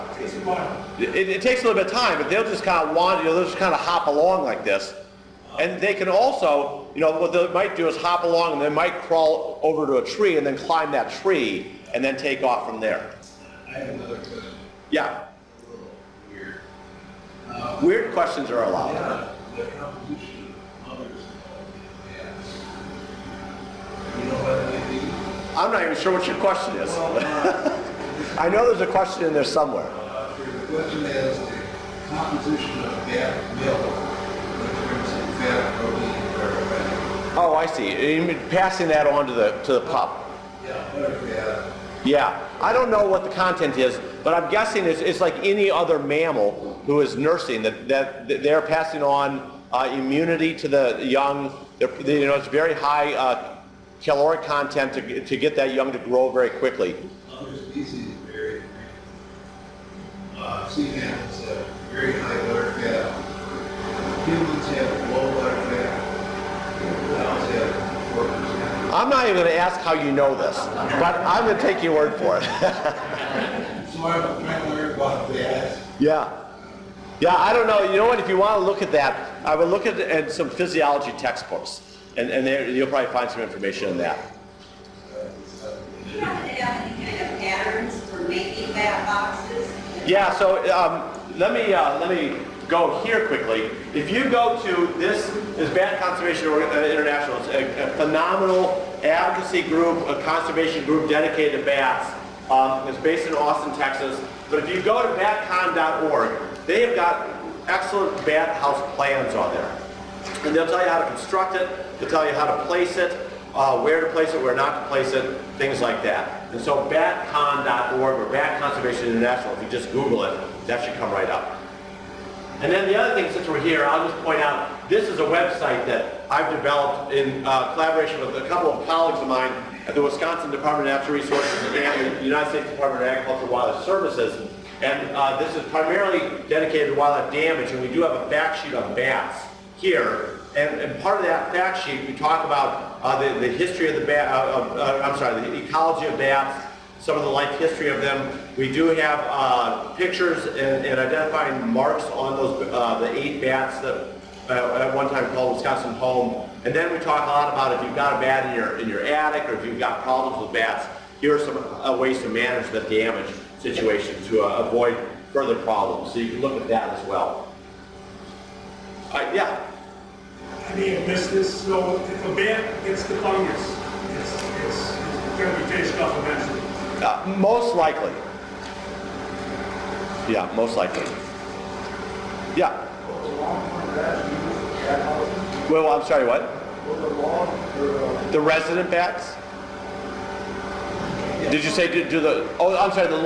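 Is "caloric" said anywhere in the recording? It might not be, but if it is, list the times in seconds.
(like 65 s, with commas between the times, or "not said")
54 s, 62 s.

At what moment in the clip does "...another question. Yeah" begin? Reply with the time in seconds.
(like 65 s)
13 s.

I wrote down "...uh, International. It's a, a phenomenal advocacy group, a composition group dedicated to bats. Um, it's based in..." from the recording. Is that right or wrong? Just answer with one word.
wrong.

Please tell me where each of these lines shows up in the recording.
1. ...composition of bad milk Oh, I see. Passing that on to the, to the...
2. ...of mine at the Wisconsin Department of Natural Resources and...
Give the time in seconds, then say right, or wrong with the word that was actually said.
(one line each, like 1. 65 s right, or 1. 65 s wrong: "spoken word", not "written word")
1. 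32 s right
2. 129 s right.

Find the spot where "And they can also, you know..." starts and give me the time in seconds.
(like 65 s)
5 s.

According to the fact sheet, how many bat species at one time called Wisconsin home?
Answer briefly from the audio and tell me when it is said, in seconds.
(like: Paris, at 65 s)
8, at 153 s.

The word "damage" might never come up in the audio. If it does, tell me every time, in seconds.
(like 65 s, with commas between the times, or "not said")
137 s, 162 s.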